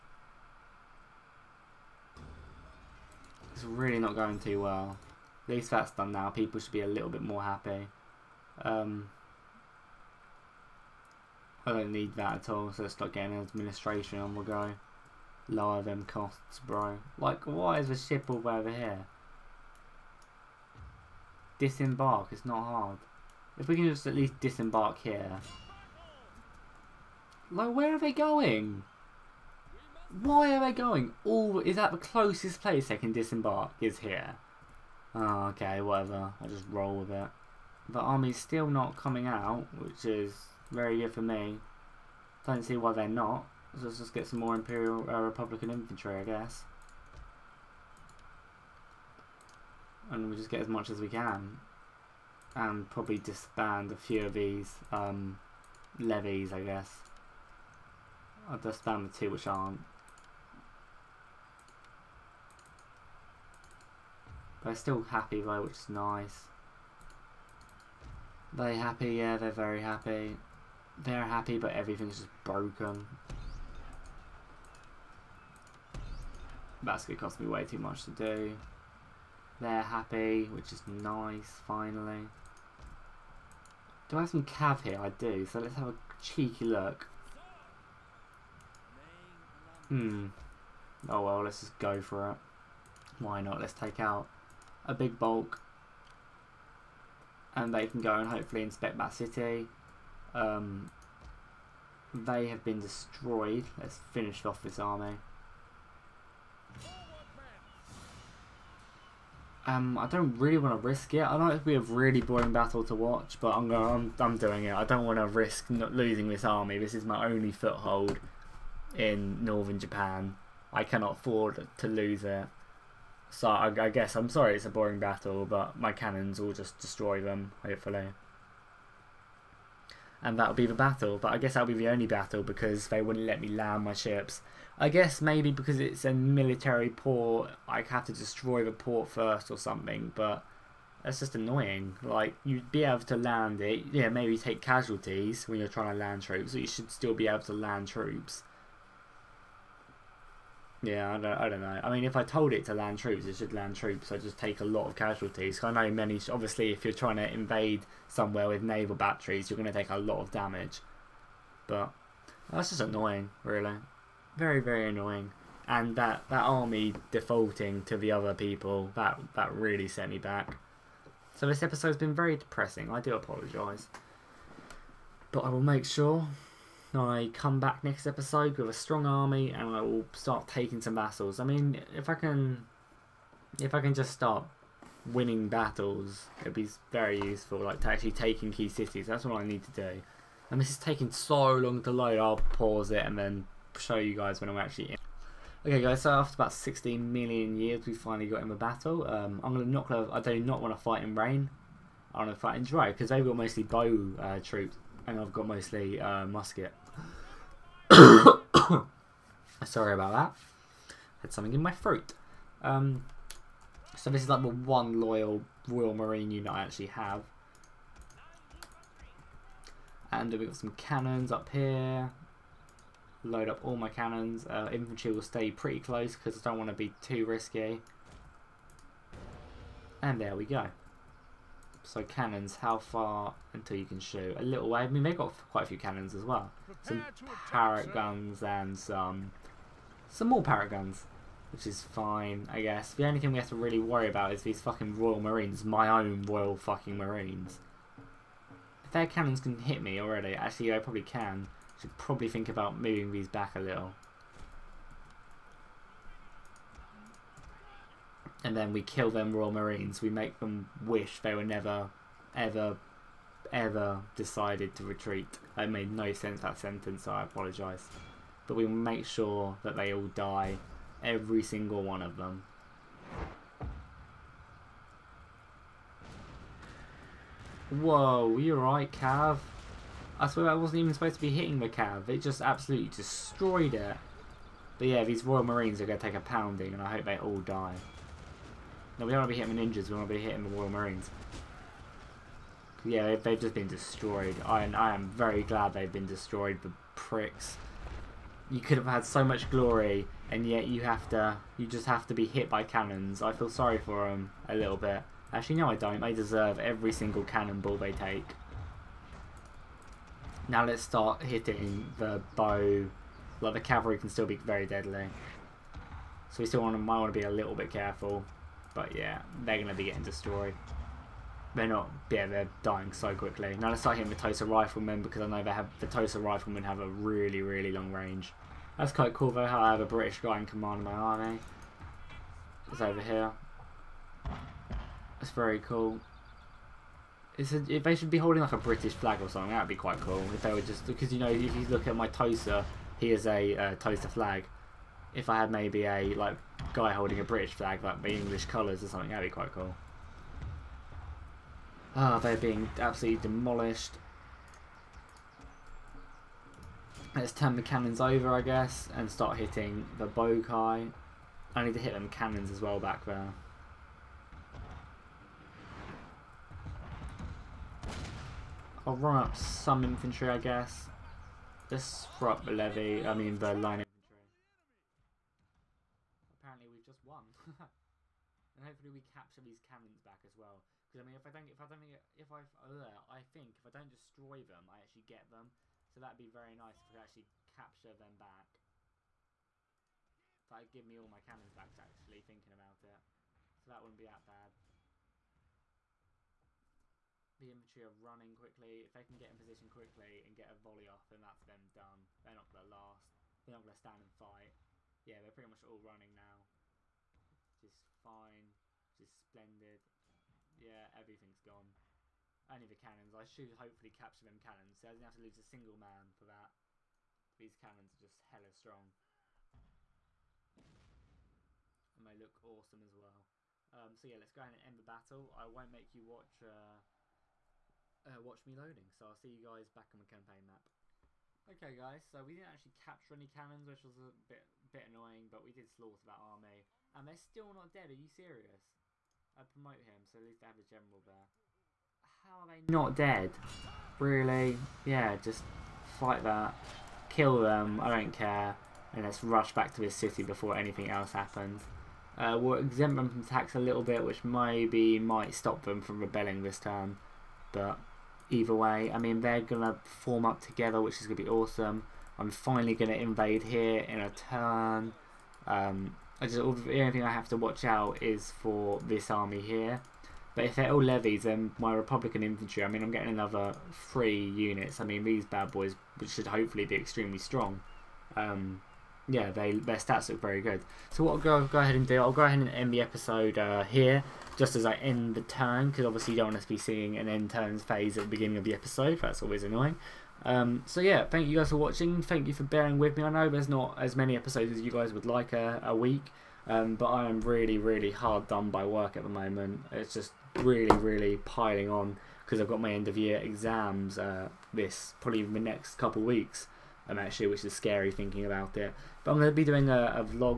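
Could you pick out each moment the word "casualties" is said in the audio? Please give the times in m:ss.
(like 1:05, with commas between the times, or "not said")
2:24, 2:34.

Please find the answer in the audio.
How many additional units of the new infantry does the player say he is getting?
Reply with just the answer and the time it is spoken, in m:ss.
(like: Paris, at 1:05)
3, at 7:53.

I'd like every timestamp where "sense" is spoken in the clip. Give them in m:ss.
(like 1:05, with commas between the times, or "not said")
4:26.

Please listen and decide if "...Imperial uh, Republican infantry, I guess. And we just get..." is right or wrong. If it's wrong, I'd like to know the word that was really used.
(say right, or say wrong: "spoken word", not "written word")
right.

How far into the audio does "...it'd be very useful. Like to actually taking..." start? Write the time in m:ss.
3:06.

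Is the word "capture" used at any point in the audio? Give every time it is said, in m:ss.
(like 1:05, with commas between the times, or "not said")
6:19, 6:27, 6:53, 7:12.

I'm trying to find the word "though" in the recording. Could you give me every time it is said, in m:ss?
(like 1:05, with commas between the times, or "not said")
1:05, 5:29.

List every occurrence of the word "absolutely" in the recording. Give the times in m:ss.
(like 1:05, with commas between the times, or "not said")
4:42, 5:52.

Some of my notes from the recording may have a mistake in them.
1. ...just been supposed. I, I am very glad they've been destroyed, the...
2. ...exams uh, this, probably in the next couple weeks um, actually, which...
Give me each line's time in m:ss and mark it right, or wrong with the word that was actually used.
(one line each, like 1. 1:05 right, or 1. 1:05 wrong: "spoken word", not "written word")
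1. 4:53 wrong: "destroyed", not "supposed"
2. 8:23 right.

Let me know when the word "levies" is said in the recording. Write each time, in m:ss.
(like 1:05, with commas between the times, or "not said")
0:55, 7:50.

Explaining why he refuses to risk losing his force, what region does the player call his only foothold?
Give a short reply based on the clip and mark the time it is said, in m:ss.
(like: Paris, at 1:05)
northern Japan, at 1:59.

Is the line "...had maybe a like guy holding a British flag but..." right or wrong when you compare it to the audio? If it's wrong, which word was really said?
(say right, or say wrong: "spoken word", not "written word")
right.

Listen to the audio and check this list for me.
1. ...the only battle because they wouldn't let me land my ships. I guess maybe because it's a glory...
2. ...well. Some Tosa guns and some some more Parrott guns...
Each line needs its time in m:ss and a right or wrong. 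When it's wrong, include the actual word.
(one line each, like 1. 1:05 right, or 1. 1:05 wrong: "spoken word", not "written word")
1. 2:11 wrong: "military", not "glory"
2. 3:56 wrong: "Parrott", not "Tosa".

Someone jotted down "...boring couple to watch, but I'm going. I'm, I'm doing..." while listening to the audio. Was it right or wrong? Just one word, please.
wrong.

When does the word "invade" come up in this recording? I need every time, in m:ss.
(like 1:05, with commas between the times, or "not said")
2:37, 7:42.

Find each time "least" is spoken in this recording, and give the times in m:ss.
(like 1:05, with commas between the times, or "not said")
0:05, 0:24, 7:20.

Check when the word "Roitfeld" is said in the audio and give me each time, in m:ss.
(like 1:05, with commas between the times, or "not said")
not said.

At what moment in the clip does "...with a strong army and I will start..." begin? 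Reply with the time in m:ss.
2:58.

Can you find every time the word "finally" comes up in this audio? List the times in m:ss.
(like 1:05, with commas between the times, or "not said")
1:21, 3:17, 7:42.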